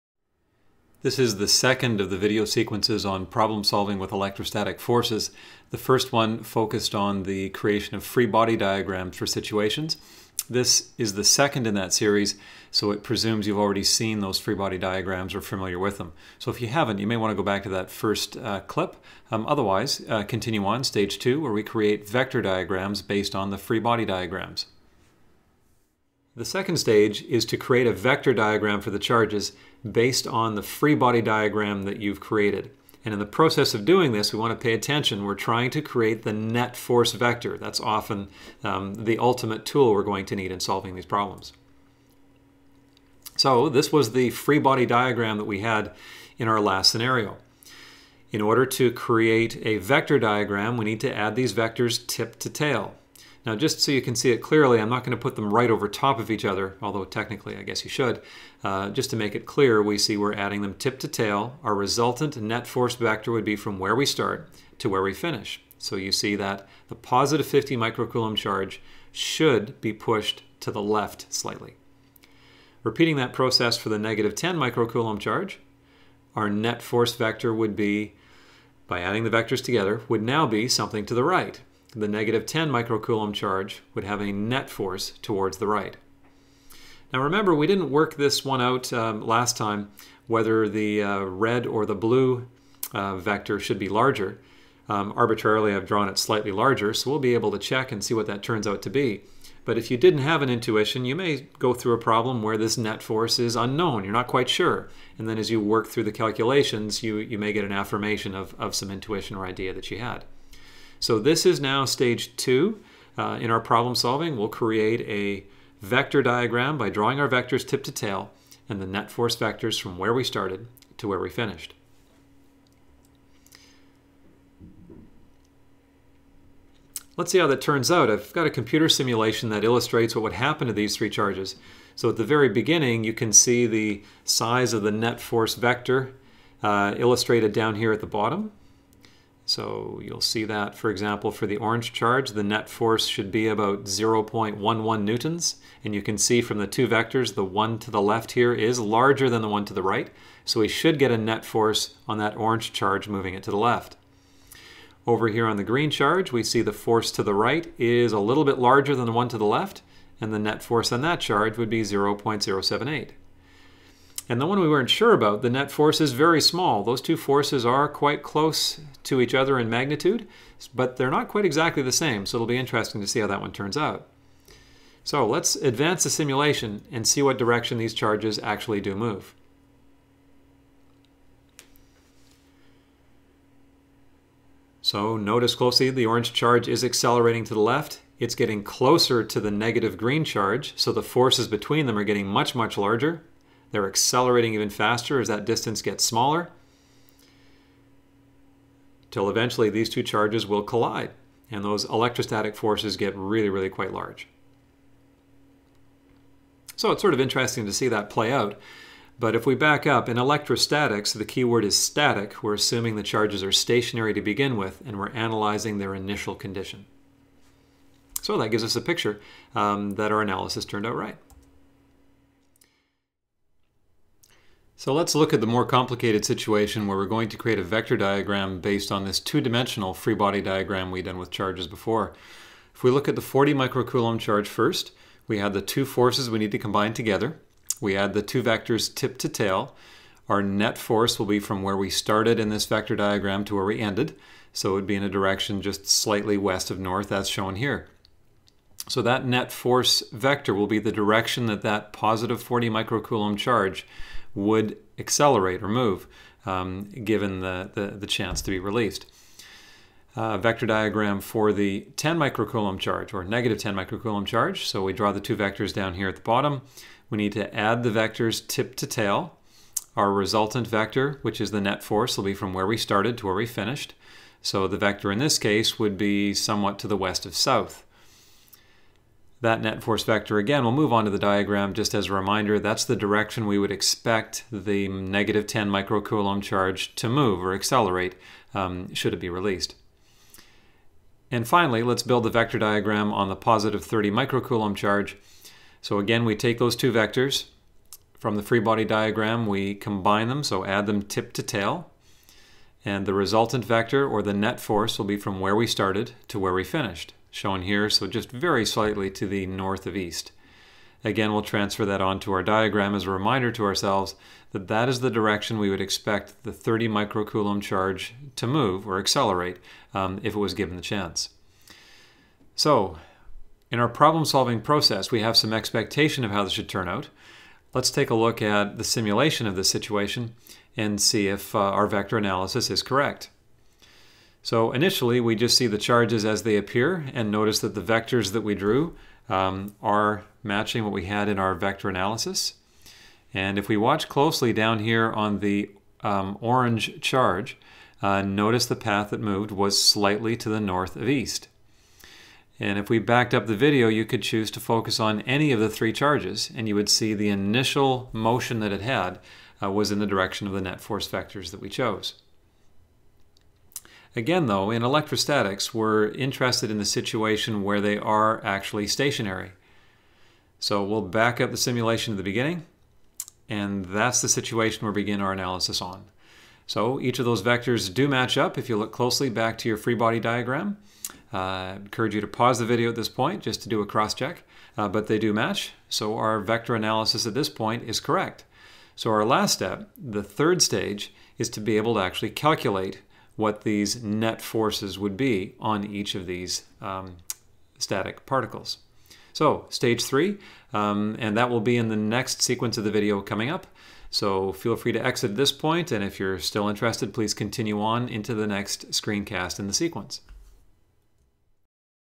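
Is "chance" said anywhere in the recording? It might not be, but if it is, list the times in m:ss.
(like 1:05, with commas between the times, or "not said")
4:18, 5:20.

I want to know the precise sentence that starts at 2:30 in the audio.
So we should get a net force on that orange charge moving it to the left.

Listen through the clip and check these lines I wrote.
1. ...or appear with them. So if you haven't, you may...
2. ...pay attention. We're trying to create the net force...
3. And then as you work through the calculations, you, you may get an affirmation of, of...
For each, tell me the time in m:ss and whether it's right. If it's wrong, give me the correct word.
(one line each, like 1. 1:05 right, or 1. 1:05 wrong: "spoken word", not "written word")
1. 0:15 wrong: "familiar", not "appear"
2. 0:34 right
3. 1:45 right.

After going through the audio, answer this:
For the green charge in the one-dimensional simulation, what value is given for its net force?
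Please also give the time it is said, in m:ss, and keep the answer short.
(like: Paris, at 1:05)
0.078, at 2:41.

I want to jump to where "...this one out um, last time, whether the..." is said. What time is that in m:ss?
1:28.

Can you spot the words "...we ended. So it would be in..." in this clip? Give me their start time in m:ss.
4:03.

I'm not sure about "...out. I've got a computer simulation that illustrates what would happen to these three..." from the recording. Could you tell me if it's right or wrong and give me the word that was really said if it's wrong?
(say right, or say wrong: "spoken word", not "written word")
right.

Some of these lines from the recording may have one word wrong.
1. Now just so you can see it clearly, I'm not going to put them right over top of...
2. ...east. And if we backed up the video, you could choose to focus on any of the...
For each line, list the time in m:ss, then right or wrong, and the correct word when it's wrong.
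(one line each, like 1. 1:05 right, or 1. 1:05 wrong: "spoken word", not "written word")
1. 0:53 right
2. 5:51 right.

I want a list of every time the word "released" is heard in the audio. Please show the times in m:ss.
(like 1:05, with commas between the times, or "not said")
4:18, 4:49.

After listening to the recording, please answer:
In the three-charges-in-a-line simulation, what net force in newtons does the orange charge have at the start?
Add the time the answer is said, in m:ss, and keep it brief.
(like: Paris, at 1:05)
0.11 newtons, at 2:23.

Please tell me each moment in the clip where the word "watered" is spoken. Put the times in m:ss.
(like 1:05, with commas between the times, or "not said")
not said.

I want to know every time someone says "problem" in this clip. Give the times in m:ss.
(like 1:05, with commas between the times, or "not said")
0:03, 0:41, 1:41, 1:53, 5:23.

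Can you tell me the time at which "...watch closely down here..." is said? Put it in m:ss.
5:43.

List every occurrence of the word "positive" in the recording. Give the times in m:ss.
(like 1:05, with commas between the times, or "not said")
1:06, 4:11, 4:53.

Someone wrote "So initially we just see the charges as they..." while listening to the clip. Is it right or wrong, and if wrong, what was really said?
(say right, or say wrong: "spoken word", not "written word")
right.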